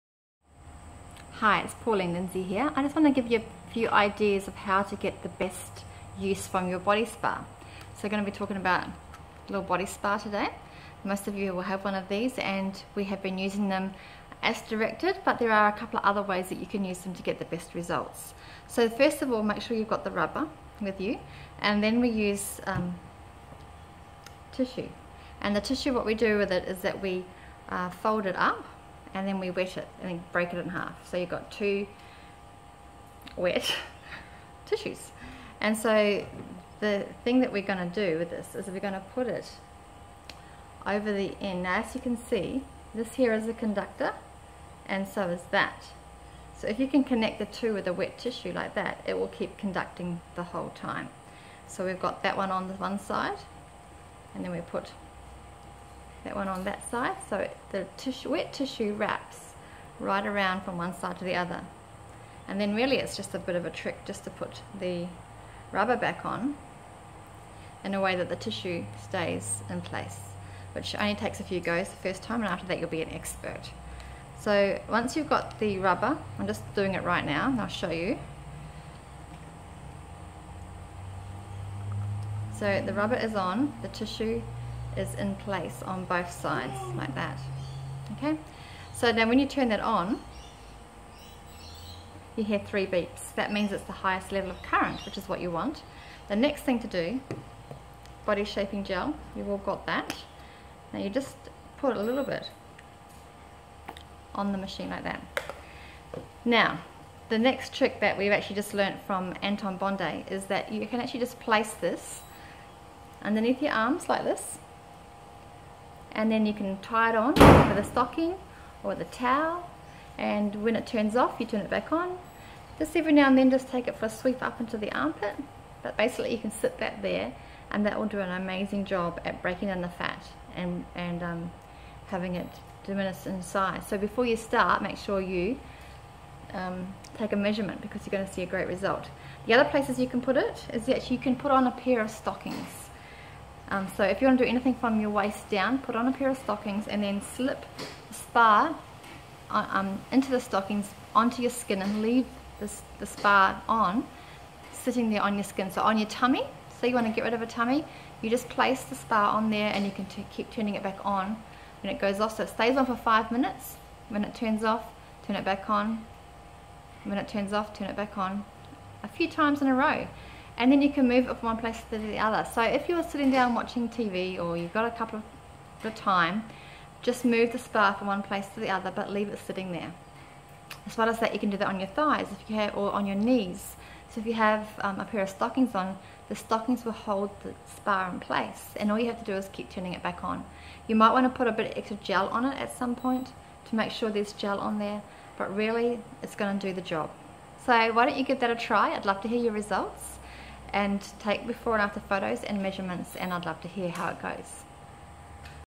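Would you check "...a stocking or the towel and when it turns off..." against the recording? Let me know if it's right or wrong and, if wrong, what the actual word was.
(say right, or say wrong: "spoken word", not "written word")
right.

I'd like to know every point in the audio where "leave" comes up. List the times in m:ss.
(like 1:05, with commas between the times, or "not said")
2:32, 2:59.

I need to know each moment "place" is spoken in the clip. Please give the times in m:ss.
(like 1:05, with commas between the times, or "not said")
1:09, 1:25, 1:51, 2:19, 2:38, 2:51, 2:58, 3:08.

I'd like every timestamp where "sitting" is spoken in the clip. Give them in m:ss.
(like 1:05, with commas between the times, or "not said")
2:34, 2:53, 2:59.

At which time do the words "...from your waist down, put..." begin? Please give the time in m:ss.
2:24.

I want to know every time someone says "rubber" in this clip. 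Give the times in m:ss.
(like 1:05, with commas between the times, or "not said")
0:20, 1:05, 1:15, 1:22.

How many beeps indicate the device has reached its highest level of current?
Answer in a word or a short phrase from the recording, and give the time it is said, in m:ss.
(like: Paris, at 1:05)
3, at 1:32.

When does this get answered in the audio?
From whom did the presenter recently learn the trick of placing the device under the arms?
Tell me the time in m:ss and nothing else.
1:49.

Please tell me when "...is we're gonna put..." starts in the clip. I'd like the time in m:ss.
0:38.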